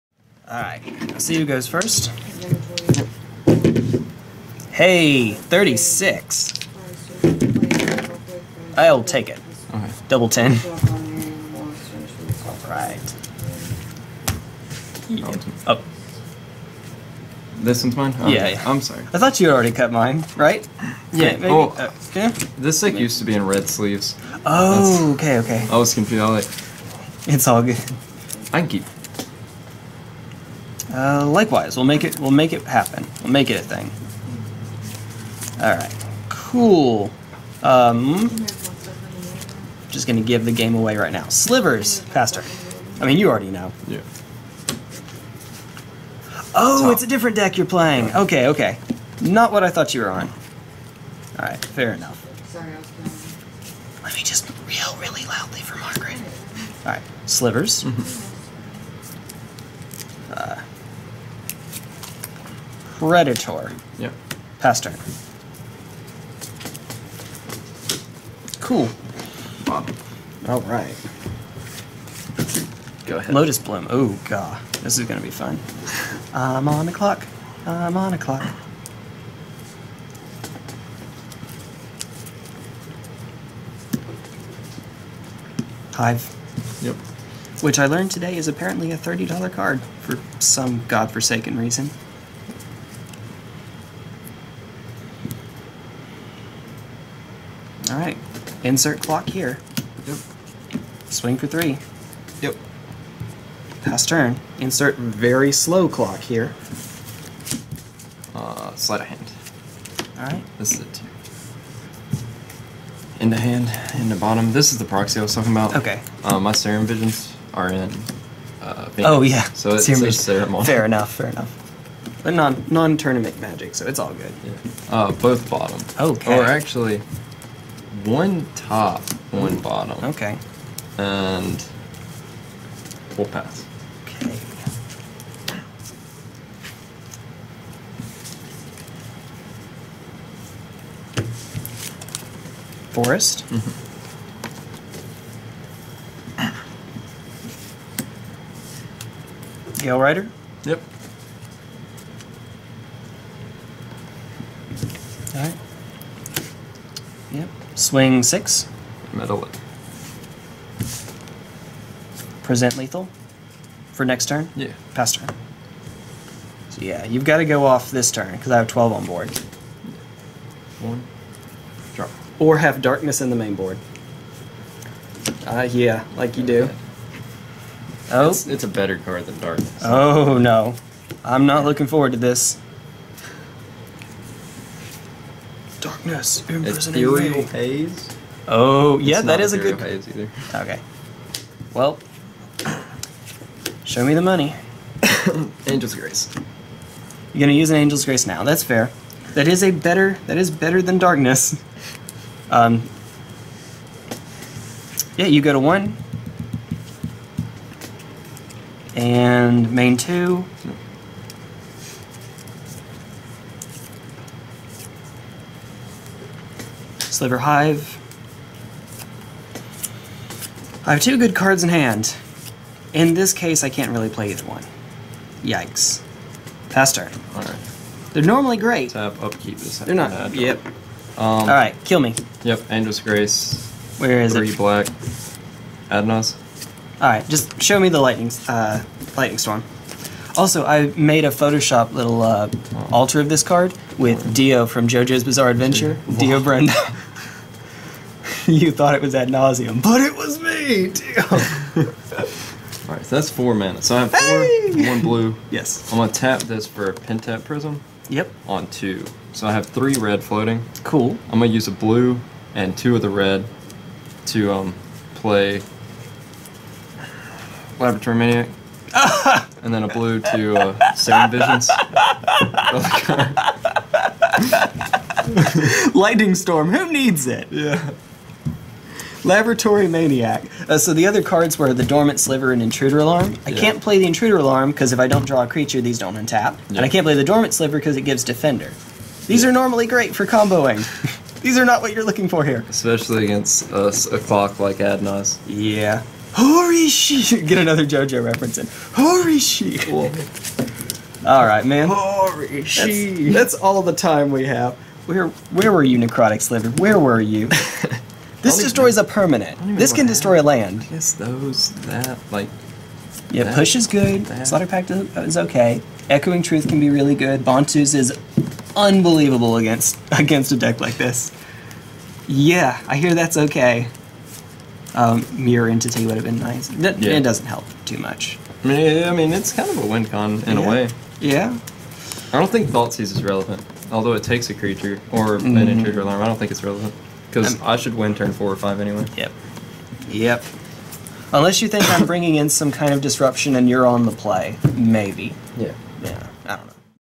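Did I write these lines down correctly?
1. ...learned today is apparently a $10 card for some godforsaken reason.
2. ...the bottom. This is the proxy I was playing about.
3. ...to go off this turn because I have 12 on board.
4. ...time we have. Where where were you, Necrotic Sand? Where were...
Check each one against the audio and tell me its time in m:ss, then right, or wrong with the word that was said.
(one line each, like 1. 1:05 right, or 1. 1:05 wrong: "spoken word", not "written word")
1. 1:27 wrong: "30", not "10"
2. 1:54 wrong: "talking", not "playing"
3. 2:47 right
4. 5:03 wrong: "Sliver", not "Sand".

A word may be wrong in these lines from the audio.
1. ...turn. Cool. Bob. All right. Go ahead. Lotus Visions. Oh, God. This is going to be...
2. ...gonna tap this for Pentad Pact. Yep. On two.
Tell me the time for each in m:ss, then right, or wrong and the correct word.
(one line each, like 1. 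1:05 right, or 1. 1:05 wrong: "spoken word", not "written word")
1. 1:04 wrong: "Bloom", not "Visions"
2. 4:15 wrong: "Prism", not "Pact".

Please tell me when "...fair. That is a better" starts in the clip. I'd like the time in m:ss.
3:18.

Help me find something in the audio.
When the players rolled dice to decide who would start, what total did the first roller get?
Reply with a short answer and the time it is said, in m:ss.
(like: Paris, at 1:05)
36, at 0:05.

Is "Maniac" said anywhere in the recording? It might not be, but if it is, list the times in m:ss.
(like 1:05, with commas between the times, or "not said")
4:28, 4:39.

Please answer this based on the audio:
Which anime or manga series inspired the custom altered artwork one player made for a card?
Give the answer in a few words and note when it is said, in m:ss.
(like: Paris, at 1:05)
JoJo's Bizarre Adventure, at 4:04.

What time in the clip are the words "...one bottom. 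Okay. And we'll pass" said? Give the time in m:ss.
2:09.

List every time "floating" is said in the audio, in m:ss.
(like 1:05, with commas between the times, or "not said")
4:20.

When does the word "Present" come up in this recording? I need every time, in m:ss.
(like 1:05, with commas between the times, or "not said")
2:42.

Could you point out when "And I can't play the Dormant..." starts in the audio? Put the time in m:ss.
4:46.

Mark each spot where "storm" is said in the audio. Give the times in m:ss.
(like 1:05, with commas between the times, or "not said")
3:59, 4:36.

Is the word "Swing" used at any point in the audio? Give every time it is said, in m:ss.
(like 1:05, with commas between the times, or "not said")
1:41, 2:37.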